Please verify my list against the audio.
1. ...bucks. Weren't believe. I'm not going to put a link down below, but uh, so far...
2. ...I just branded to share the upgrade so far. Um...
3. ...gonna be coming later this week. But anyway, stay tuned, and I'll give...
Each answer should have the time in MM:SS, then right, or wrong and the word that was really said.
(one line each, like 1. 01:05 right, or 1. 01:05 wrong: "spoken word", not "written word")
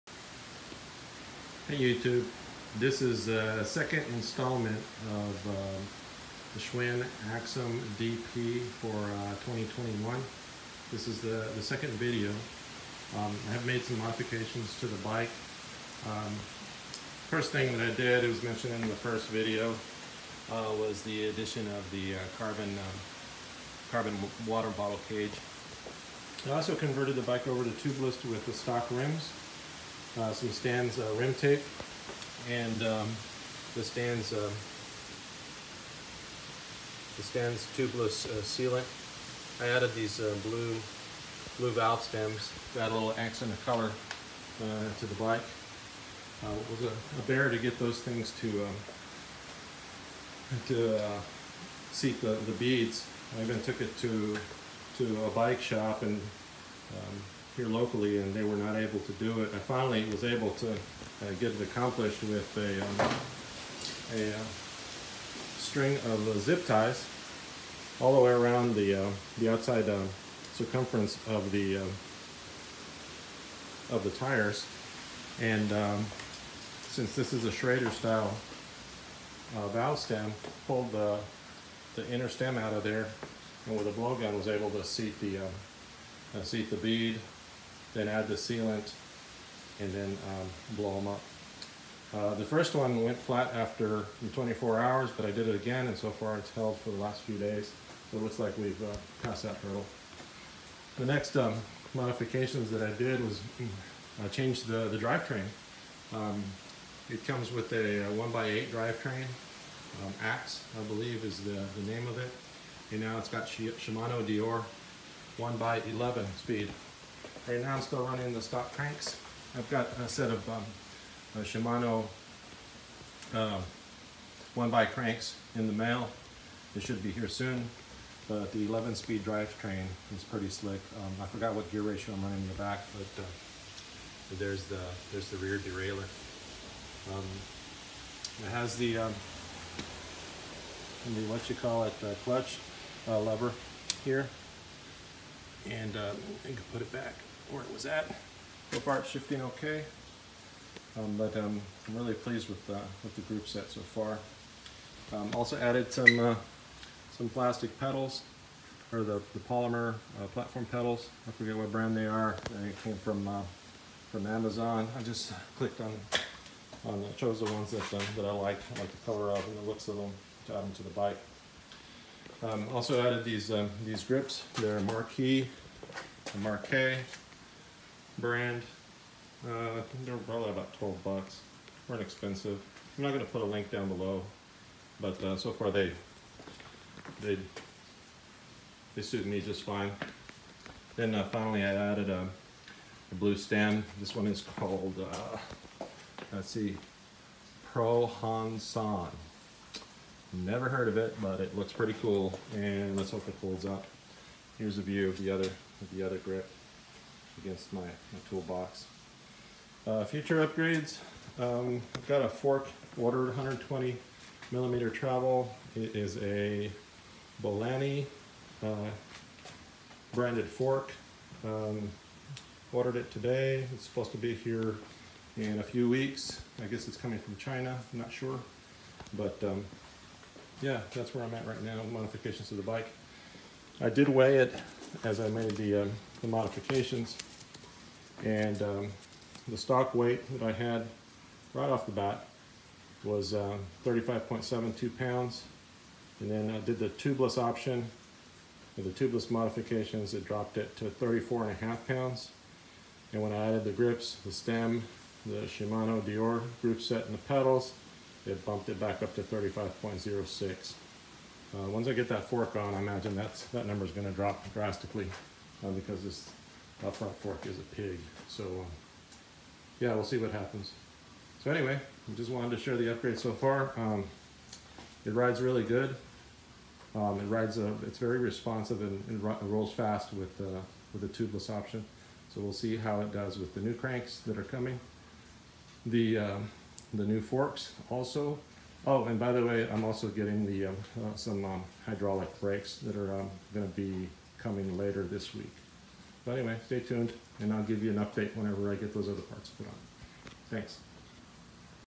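1. 03:01 wrong: "expensive", not "believe"
2. 04:31 wrong: "wanted", not "branded"
3. 04:53 right.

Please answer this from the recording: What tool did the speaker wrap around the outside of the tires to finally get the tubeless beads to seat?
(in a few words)
zip ties.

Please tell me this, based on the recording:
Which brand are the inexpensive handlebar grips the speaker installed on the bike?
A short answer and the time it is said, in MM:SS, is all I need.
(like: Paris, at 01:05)
Marquee, at 02:54.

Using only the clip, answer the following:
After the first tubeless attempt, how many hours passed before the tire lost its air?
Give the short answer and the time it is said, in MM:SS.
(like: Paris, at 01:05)
24, at 01:34.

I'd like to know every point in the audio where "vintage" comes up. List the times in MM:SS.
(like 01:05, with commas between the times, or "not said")
not said.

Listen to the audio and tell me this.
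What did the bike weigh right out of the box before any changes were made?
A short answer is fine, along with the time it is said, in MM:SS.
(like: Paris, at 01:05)
35.72 pounds, at 04:03.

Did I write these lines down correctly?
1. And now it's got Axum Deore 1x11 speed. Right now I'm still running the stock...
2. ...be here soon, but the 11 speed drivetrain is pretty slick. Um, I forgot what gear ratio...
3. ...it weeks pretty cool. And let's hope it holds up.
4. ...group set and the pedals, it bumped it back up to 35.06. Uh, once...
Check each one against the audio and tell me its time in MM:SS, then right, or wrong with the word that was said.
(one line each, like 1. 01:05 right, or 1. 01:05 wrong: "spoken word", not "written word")
1. 01:52 wrong: "Shimano", not "Axum"
2. 02:07 right
3. 03:21 wrong: "looks", not "weeks"
4. 04:16 right.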